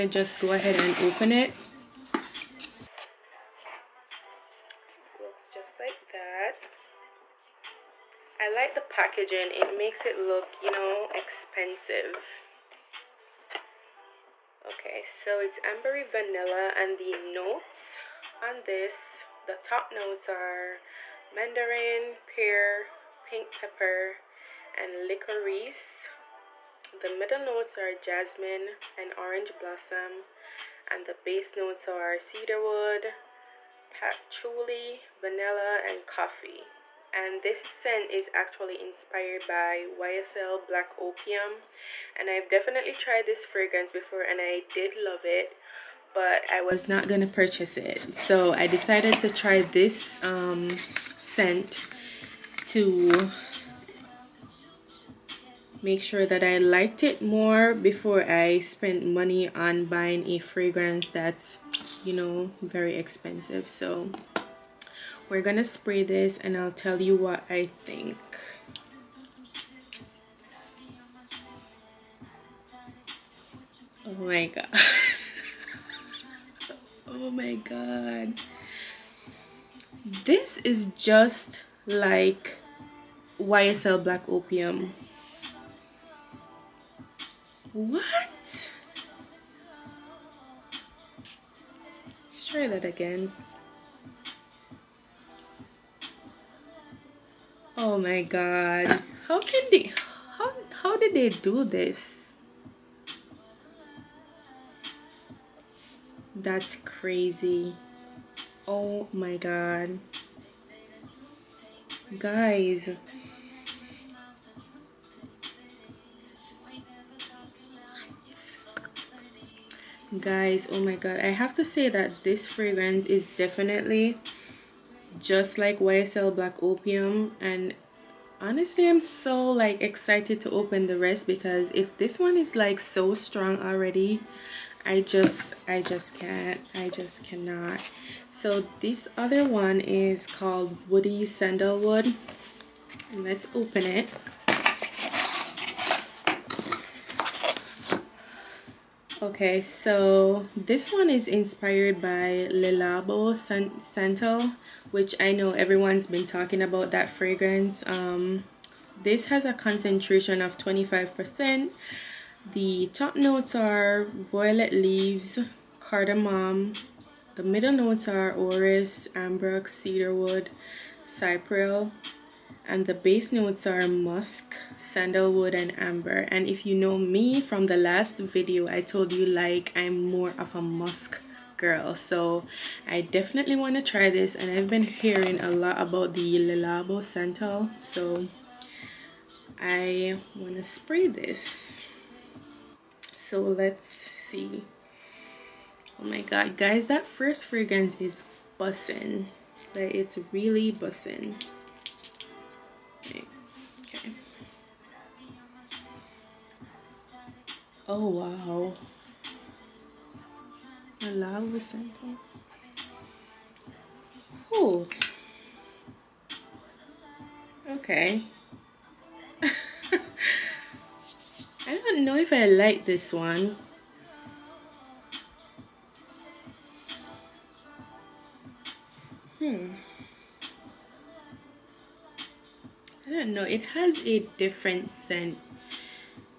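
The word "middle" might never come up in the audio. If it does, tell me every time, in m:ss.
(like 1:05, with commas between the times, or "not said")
0:27, 2:47.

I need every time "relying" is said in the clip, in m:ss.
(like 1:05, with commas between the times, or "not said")
not said.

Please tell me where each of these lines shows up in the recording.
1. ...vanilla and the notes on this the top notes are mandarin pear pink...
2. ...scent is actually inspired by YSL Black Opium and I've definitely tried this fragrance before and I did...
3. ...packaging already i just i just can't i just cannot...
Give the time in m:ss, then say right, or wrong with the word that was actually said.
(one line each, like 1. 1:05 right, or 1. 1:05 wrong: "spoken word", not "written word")
1. 0:16 right
2. 0:37 right
3. 2:13 wrong: "strong", not "packaging".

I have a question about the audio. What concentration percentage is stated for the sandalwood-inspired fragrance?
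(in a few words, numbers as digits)
25%.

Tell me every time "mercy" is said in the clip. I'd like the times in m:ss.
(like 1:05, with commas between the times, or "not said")
not said.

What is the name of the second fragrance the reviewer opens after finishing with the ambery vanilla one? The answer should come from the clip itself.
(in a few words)
Woody Sandalwood.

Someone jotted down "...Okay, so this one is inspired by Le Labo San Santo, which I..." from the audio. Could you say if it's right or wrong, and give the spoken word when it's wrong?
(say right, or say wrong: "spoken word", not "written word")
right.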